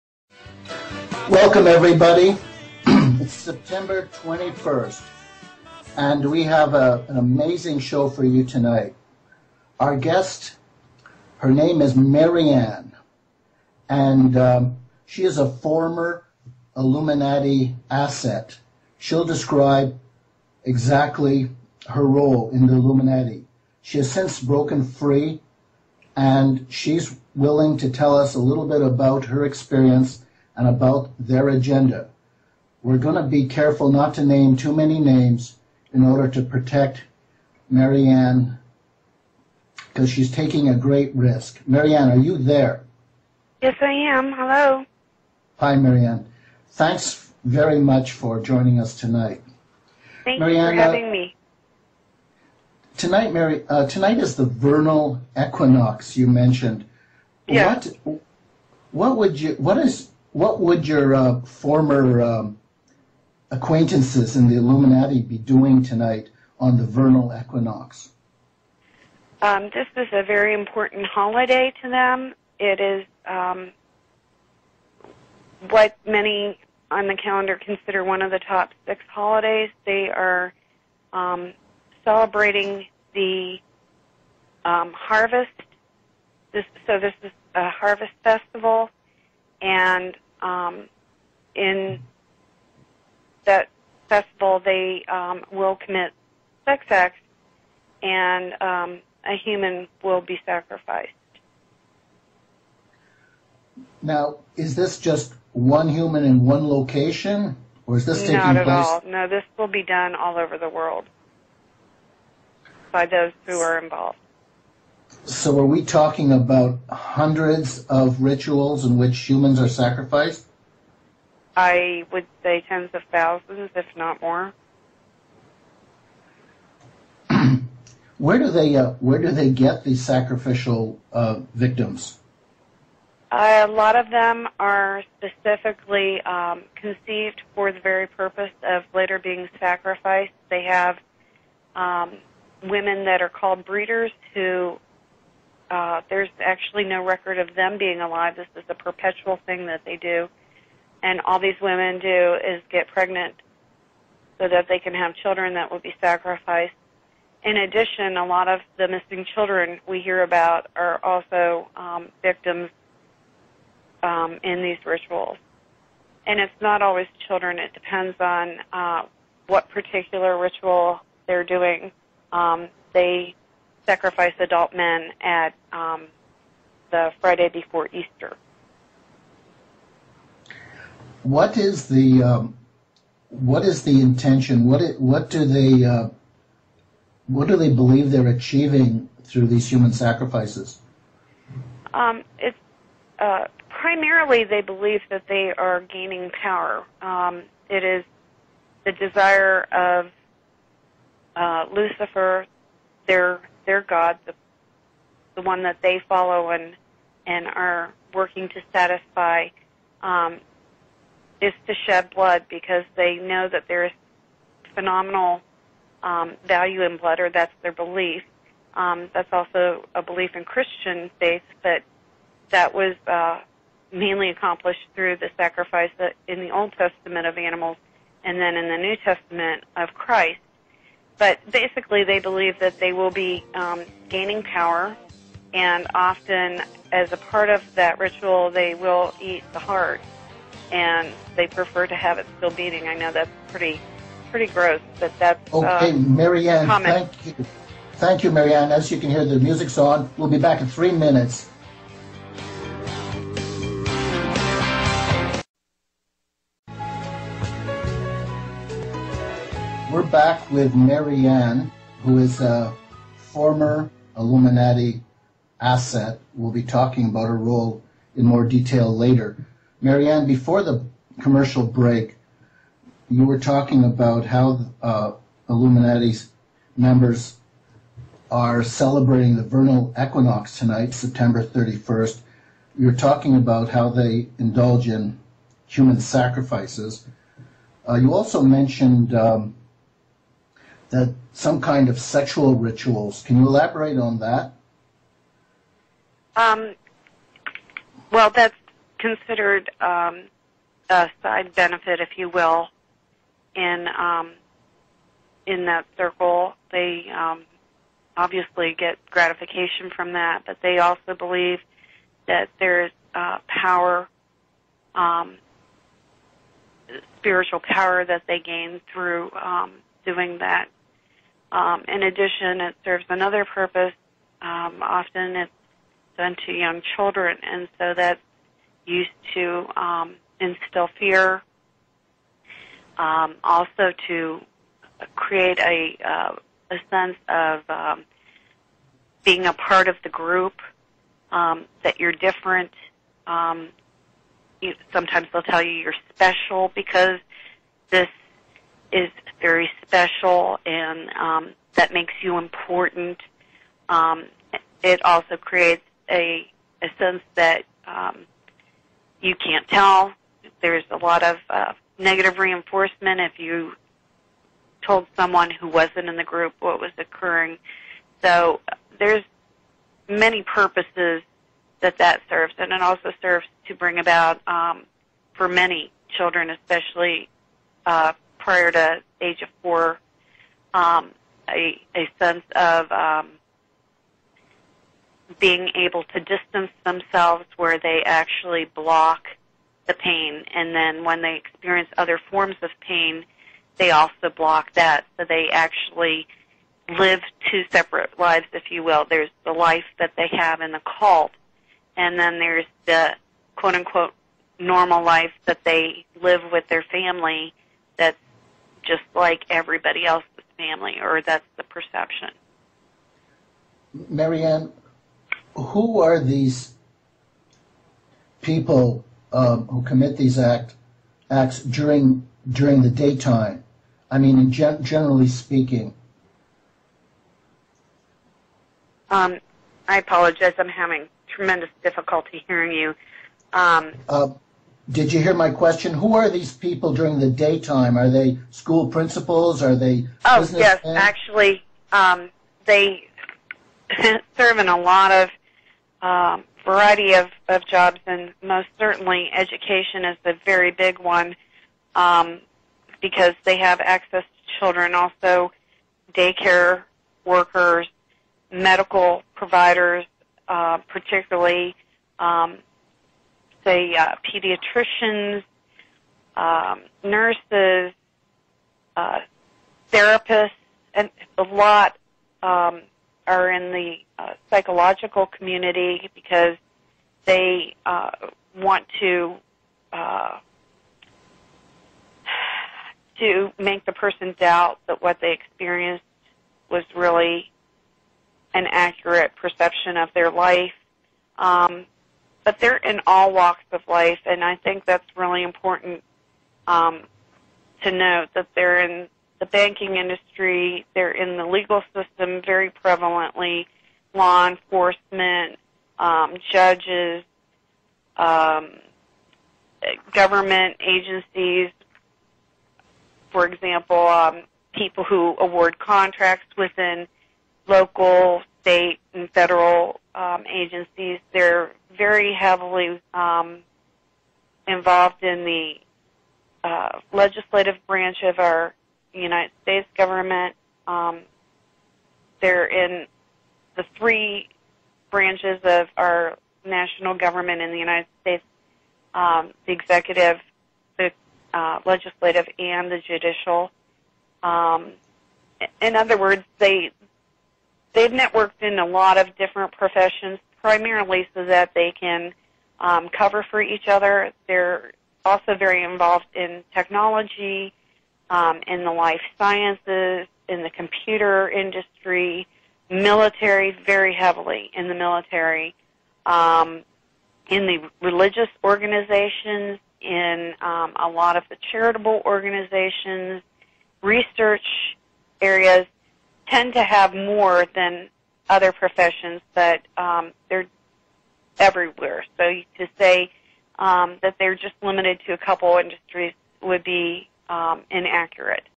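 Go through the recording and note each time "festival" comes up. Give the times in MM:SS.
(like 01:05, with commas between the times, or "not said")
01:28, 01:34.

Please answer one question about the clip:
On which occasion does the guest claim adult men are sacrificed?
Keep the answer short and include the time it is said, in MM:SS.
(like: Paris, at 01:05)
The Friday before Easter, at 02:56.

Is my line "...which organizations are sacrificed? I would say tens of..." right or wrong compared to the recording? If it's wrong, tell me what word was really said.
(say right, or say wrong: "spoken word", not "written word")
wrong: "humans", not "organizations".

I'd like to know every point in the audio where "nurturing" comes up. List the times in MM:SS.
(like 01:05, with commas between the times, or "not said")
not said.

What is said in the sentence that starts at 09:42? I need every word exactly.
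So to say um, that they're just limited to a couple industries would be um, inaccurate.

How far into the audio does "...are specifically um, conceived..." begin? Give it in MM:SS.
02:14.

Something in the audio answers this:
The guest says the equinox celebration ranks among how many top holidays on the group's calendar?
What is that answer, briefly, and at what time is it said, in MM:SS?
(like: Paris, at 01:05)
6, at 01:18.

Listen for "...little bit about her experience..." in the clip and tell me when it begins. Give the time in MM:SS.
00:28.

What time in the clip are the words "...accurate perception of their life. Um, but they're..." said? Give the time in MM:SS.
08:08.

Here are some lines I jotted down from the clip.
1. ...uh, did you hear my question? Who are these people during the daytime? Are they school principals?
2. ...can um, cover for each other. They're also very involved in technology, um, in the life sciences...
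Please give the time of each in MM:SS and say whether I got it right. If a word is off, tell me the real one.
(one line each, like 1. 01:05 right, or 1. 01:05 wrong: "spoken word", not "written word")
1. 07:14 right
2. 09:11 right.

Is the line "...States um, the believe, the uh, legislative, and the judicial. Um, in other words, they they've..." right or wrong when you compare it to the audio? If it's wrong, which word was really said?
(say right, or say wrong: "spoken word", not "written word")
wrong: "executive", not "believe".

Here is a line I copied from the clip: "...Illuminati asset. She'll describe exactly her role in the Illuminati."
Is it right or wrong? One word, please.
right.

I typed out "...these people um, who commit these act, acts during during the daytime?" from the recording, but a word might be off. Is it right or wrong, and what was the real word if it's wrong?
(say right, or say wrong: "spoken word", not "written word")
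right.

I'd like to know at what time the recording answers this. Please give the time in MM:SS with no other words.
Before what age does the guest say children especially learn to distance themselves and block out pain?
06:19.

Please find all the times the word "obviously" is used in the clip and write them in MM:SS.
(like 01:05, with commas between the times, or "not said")
05:08.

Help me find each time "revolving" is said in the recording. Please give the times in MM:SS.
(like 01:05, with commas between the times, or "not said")
not said.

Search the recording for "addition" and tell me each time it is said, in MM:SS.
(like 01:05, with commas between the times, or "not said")
02:37, 05:22.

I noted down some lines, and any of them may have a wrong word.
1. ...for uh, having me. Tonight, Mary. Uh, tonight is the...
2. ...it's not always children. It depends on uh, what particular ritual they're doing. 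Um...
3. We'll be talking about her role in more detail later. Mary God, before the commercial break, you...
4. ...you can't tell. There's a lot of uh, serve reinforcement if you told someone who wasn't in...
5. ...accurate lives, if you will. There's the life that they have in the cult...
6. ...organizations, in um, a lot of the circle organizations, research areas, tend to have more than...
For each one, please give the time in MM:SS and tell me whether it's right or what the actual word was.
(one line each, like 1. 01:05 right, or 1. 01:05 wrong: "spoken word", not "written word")
1. 00:50 right
2. 02:46 right
3. 04:26 wrong: "Ann", not "God"
4. 05:59 wrong: "negative", not "serve"
5. 06:37 wrong: "separate", not "accurate"
6. 09:28 wrong: "charitable", not "circle".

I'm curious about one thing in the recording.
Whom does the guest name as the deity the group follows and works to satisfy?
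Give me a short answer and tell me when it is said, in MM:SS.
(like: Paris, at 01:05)
Lucifer, at 03:21.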